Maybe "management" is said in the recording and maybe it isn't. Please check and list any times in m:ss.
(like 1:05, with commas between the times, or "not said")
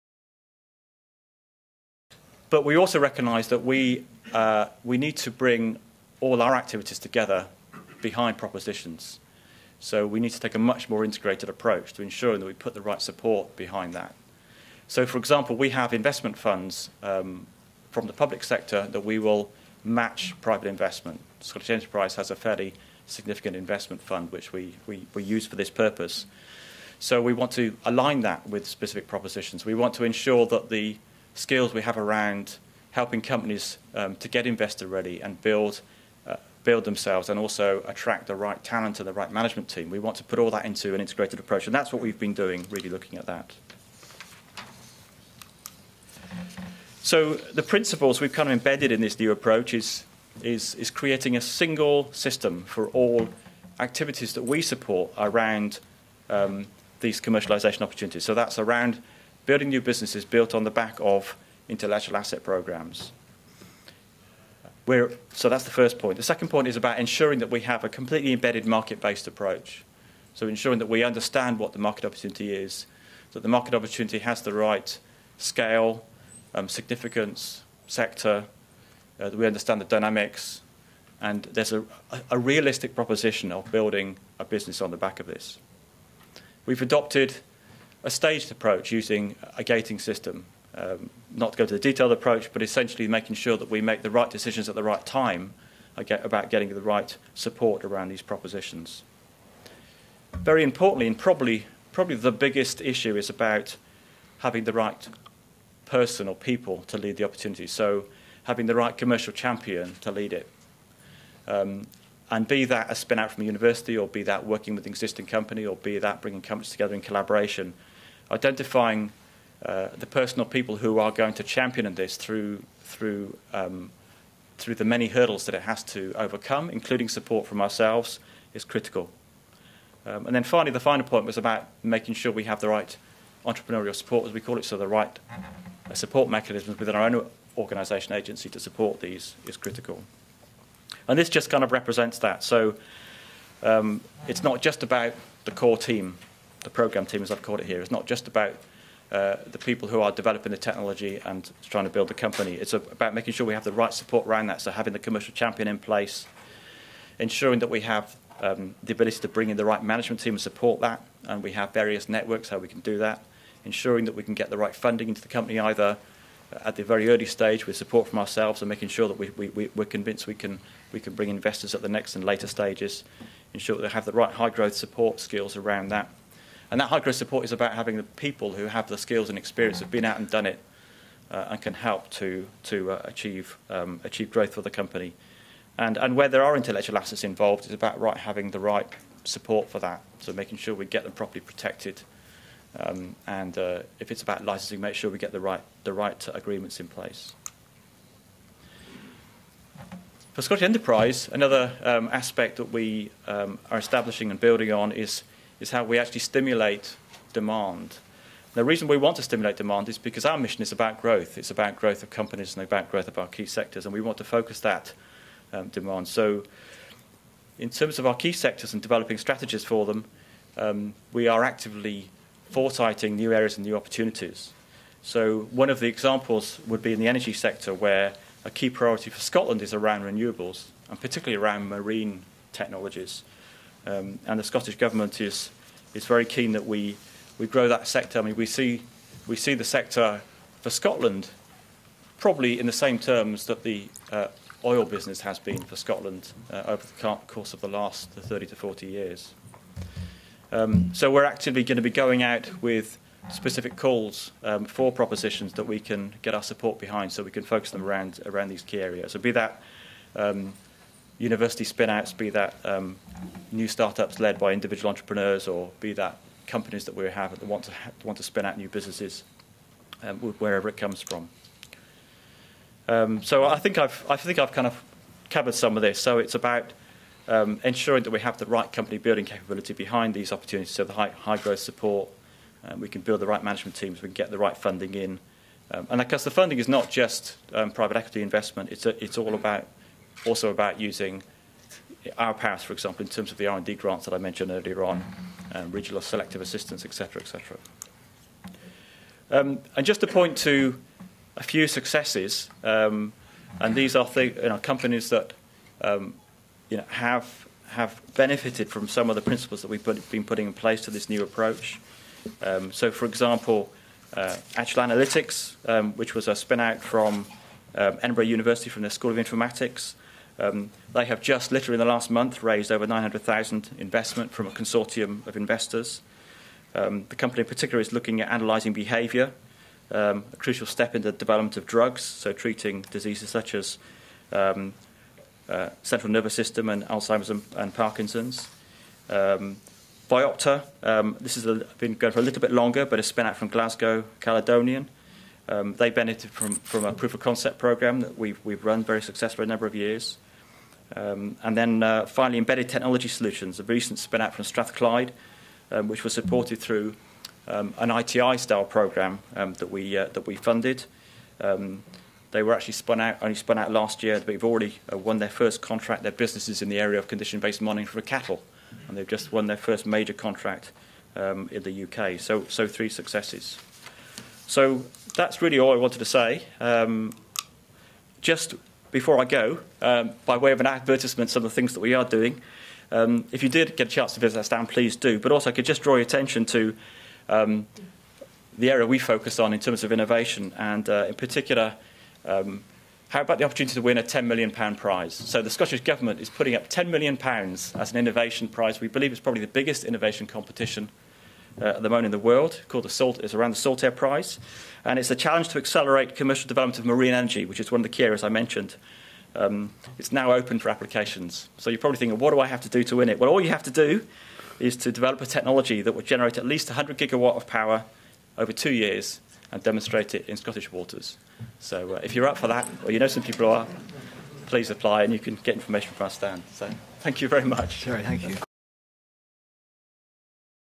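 0:39, 2:39, 4:43.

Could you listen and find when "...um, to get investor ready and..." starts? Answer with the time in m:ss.
0:33.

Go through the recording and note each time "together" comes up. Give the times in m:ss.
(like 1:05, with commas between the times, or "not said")
0:06, 1:56.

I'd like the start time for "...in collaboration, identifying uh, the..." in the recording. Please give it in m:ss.
1:56.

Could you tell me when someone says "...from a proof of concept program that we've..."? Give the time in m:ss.
5:46.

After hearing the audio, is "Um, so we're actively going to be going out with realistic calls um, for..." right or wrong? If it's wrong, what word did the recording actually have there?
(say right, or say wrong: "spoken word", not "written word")
wrong: "specific", not "realistic".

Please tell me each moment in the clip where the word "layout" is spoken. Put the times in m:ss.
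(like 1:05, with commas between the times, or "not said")
not said.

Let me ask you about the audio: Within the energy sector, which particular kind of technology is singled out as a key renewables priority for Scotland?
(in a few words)
marine technologies.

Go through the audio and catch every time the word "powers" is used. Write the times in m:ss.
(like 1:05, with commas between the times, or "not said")
4:52, 6:57.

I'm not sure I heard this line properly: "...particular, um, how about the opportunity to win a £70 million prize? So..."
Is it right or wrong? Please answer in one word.
wrong.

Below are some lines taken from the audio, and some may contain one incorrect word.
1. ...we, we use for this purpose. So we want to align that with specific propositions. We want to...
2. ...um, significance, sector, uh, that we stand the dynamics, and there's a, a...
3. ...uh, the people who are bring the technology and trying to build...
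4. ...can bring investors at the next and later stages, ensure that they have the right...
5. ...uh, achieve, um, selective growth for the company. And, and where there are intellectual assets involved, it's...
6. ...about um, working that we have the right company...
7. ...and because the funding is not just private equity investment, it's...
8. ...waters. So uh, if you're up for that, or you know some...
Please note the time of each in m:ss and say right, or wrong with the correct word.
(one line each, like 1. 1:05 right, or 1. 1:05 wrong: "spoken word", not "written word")
1. 0:24 right
2. 1:16 wrong: "understand", not "stand"
3. 2:29 wrong: "developing", not "bring"
4. 2:50 right
5. 3:02 wrong: "achieve", not "selective"
6. 4:36 wrong: "ensuring", not "working"
7. 4:45 right
8. 7:00 right.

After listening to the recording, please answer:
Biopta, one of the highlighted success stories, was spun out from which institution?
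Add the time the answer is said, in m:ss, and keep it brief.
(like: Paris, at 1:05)
Glasgow Caledonian, at 5:43.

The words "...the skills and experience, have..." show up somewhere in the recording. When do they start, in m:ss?
2:58.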